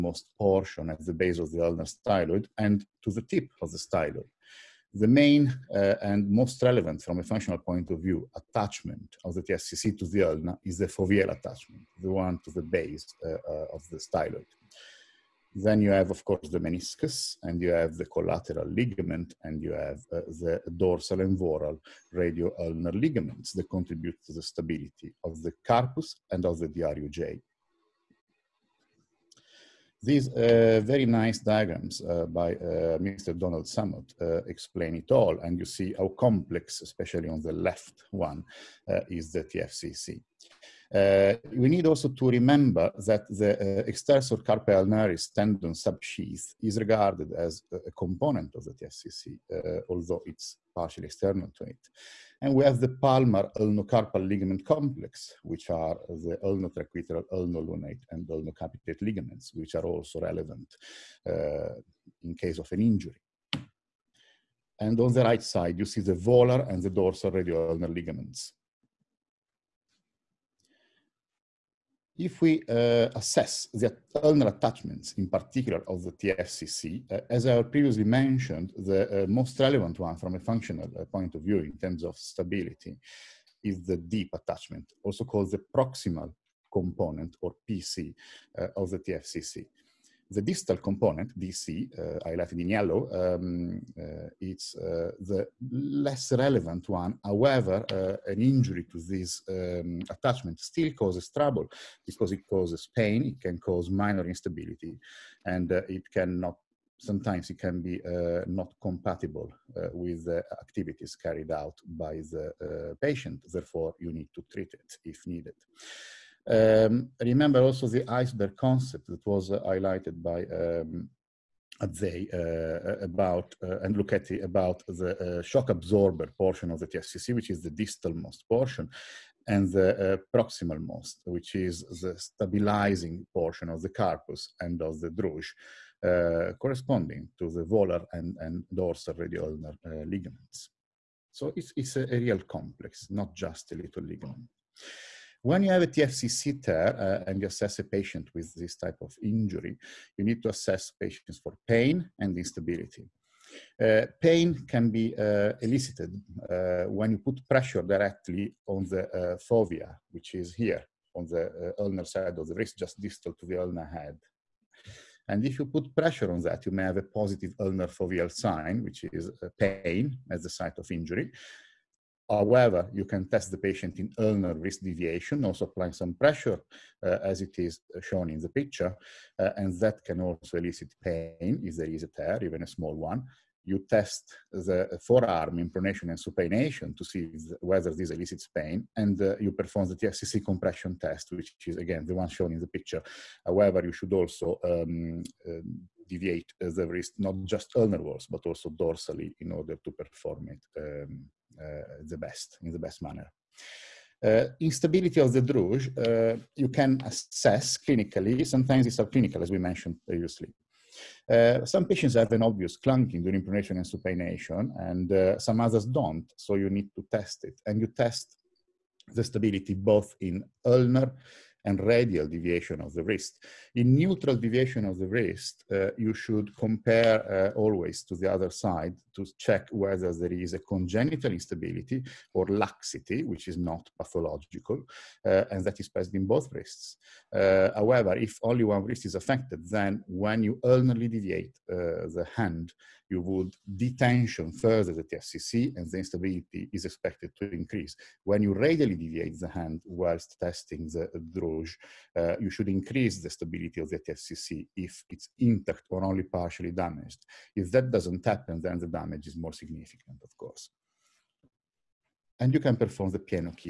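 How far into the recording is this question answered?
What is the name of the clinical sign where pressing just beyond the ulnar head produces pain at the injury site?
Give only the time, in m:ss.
2:47.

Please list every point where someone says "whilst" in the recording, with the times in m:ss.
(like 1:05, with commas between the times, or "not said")
4:09.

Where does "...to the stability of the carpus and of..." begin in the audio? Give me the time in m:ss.
0:24.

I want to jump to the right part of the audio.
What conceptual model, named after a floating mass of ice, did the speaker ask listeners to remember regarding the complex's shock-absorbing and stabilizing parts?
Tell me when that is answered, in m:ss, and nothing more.
1:58.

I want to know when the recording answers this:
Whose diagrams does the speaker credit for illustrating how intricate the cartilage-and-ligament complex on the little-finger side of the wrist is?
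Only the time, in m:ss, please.
0:32.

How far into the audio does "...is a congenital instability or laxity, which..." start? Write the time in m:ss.
3:50.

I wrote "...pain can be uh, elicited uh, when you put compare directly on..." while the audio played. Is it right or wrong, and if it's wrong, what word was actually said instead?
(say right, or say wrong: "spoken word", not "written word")
wrong: "pressure", not "compare".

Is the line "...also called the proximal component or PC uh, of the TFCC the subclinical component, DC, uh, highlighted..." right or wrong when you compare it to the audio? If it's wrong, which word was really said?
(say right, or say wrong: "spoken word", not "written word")
wrong: "distal", not "subclinical".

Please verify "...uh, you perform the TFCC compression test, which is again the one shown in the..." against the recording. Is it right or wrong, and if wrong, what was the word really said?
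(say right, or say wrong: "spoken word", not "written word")
right.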